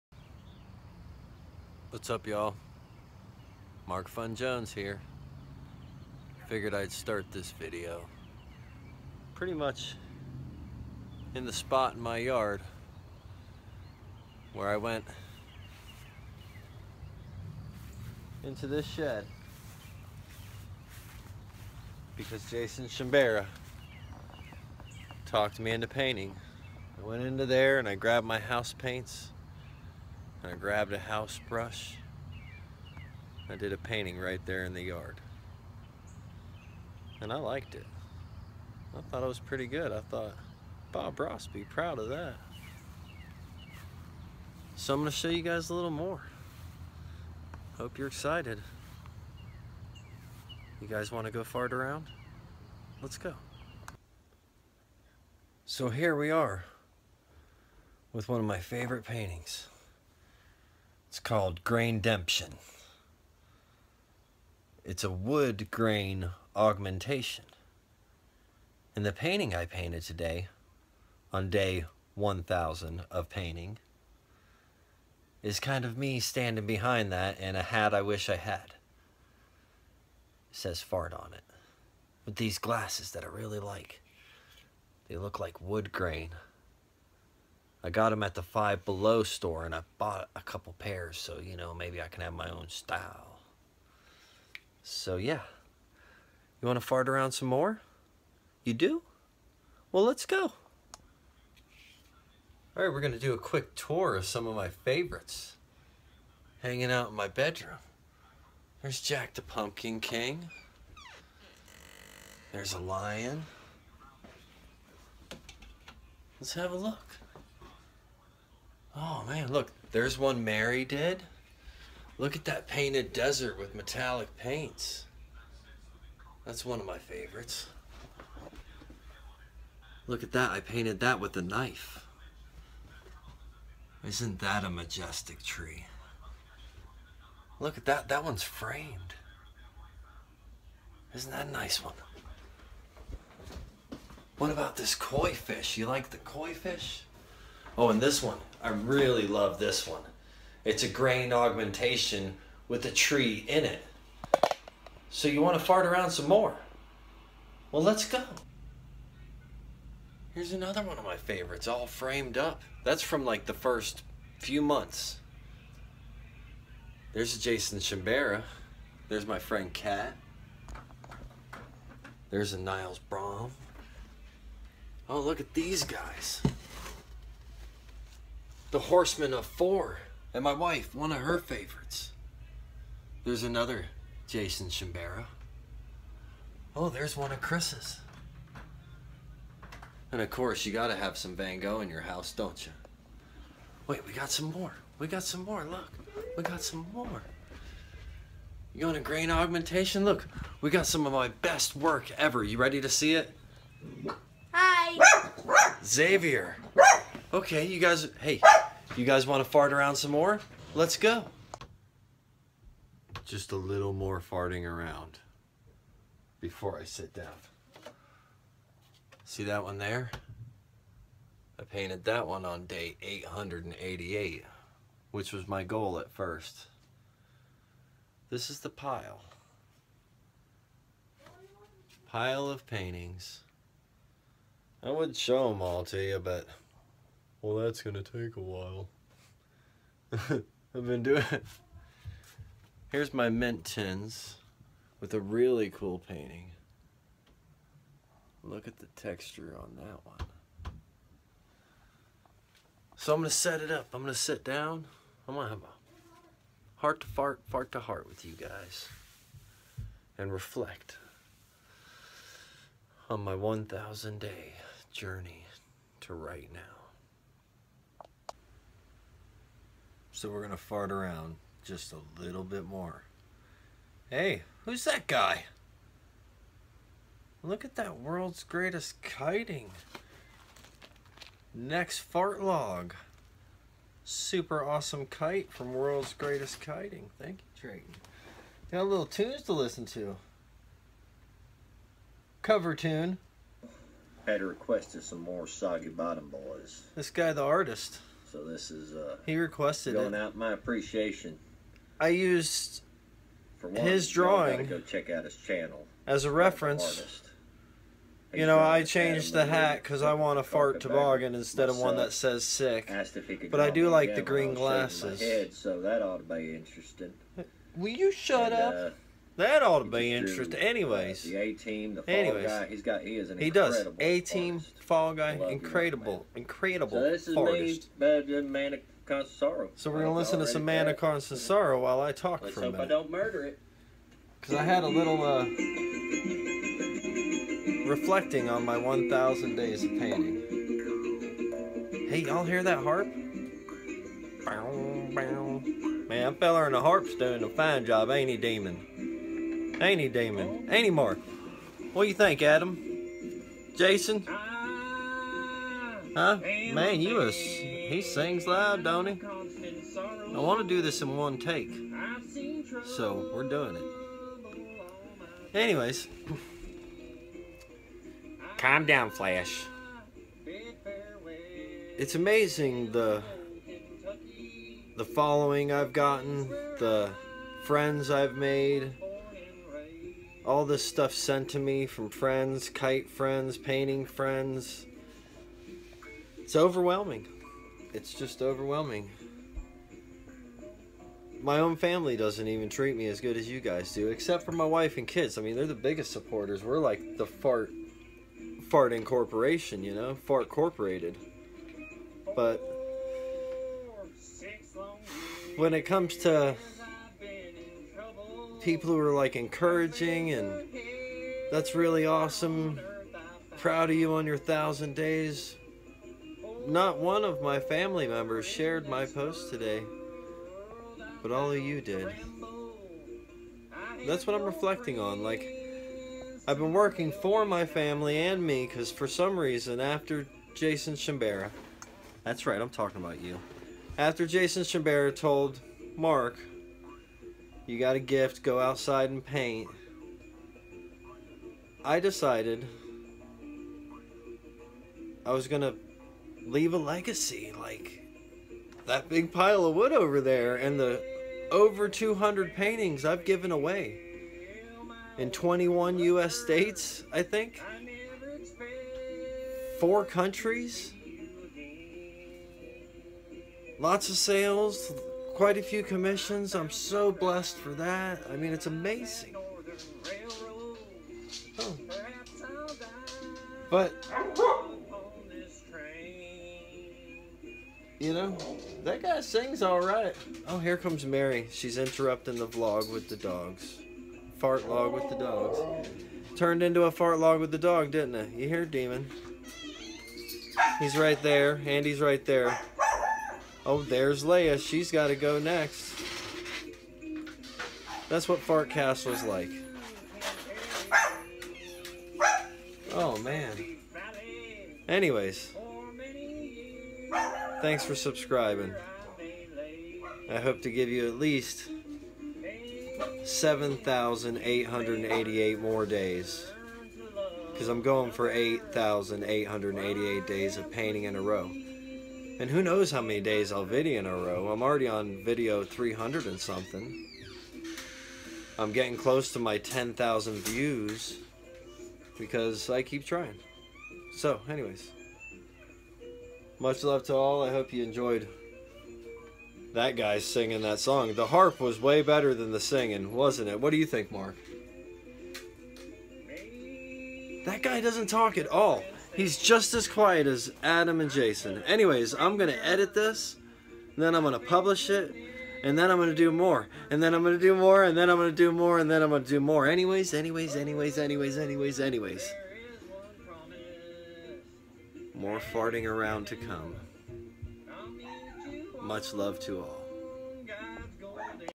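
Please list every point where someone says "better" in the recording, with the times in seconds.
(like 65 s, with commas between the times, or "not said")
327 s, 542 s.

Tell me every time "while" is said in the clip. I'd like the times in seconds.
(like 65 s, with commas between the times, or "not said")
238 s, 331 s.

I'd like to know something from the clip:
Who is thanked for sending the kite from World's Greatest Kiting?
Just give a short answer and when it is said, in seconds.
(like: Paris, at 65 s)
Drayton, at 287 s.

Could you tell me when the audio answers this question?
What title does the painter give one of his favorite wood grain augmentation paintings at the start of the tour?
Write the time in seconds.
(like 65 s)
61 s.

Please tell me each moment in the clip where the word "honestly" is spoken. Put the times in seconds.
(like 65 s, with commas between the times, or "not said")
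not said.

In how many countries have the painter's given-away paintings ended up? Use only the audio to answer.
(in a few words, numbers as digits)
4.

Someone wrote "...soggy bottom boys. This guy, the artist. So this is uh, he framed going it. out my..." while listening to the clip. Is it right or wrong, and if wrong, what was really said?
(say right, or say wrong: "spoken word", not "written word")
wrong: "requested", not "framed".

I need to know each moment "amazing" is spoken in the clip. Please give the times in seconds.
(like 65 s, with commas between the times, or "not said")
372 s, 468 s.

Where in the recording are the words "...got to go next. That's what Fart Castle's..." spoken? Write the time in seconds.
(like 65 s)
494 s.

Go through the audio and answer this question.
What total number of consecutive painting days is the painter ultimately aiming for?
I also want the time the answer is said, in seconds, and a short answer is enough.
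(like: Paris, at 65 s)
8,888, at 518 s.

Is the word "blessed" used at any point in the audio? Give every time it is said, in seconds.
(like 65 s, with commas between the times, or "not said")
467 s.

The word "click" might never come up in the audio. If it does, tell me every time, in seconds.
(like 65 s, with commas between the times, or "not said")
not said.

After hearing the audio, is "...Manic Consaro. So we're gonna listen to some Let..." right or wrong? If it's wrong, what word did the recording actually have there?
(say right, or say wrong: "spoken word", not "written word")
wrong: "Manic", not "Let".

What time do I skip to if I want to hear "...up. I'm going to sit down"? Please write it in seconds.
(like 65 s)
253 s.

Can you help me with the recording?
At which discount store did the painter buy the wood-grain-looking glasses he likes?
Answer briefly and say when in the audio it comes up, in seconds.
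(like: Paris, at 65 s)
Five Below, at 88 s.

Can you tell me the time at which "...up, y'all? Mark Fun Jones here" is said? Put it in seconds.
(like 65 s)
2 s.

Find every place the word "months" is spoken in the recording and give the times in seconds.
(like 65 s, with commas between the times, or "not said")
164 s.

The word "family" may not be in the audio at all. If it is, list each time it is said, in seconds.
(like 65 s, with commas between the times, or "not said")
391 s, 417 s, 427 s.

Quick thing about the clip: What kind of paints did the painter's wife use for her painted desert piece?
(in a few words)
Metallic paints.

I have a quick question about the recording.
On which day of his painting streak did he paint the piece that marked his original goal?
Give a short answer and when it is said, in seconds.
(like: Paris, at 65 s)
888, at 222 s.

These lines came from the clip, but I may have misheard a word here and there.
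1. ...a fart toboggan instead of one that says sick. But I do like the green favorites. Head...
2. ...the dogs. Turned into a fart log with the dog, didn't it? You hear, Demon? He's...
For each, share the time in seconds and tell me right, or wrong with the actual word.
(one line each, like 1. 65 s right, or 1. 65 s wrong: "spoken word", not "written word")
1. 310 s wrong: "glasses", not "favorites"
2. 485 s right.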